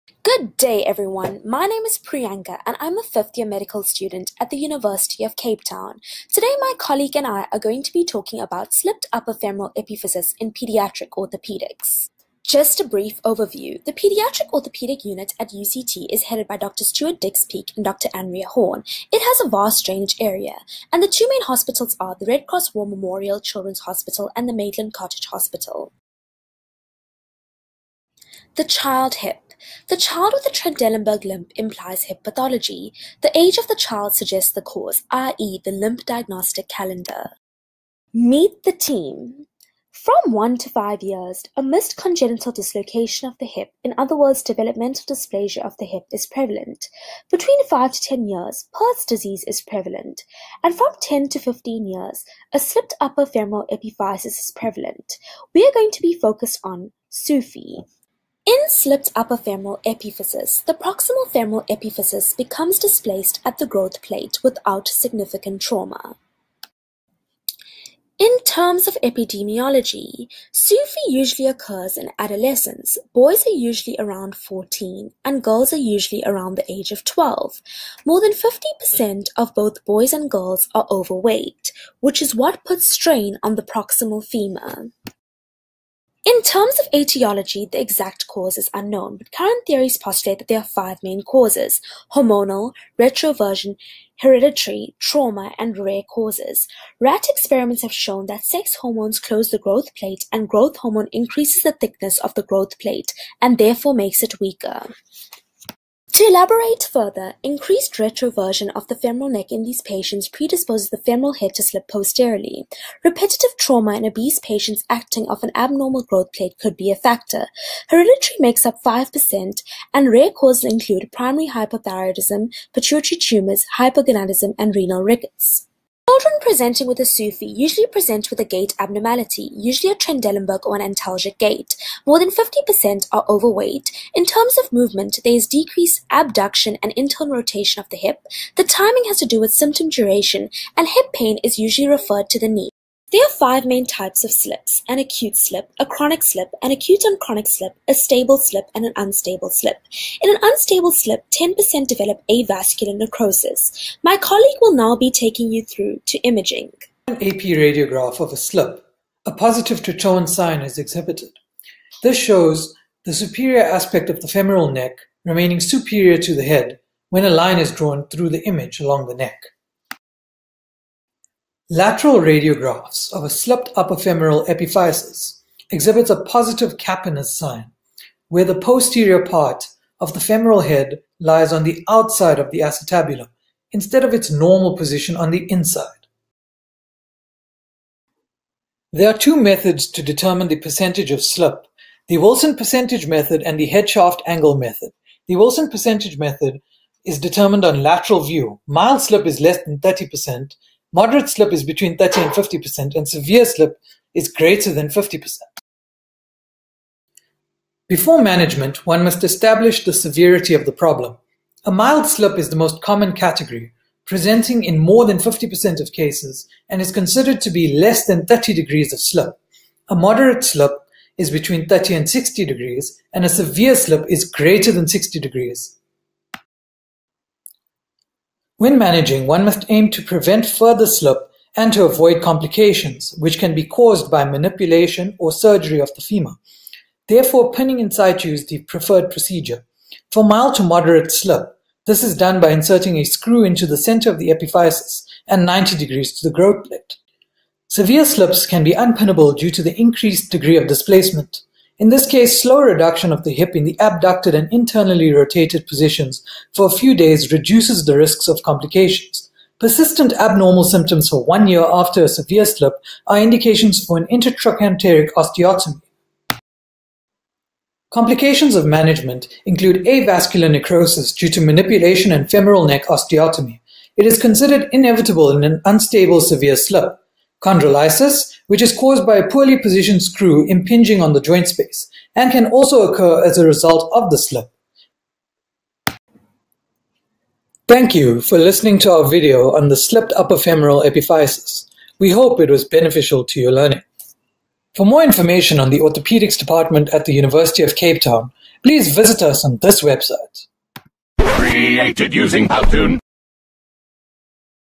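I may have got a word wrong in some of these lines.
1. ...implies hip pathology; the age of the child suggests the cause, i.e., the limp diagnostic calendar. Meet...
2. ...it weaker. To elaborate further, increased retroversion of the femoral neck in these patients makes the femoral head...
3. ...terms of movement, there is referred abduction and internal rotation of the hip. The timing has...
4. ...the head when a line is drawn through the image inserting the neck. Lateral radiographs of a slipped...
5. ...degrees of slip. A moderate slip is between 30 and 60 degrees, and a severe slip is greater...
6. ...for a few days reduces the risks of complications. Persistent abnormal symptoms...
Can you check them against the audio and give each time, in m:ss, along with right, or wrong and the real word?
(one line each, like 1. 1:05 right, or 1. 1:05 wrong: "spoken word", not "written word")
1. 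0:31 right
2. 1:44 wrong: "predisposes", not "makes"
3. 2:14 wrong: "decreased", not "referred"
4. 2:46 wrong: "along", not "inserting"
5. 3:38 right
6. 4:16 right.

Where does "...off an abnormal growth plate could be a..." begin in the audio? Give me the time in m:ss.
1:55.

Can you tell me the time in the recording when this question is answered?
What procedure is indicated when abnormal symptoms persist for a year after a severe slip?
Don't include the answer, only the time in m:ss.
4:24.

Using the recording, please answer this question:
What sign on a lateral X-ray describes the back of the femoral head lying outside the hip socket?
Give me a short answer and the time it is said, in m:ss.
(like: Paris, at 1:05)
Capener's sign, at 2:56.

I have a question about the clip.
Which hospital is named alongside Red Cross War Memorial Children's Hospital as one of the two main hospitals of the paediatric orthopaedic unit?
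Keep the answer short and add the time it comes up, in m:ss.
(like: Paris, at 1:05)
Maitland Cottage Hospital, at 0:24.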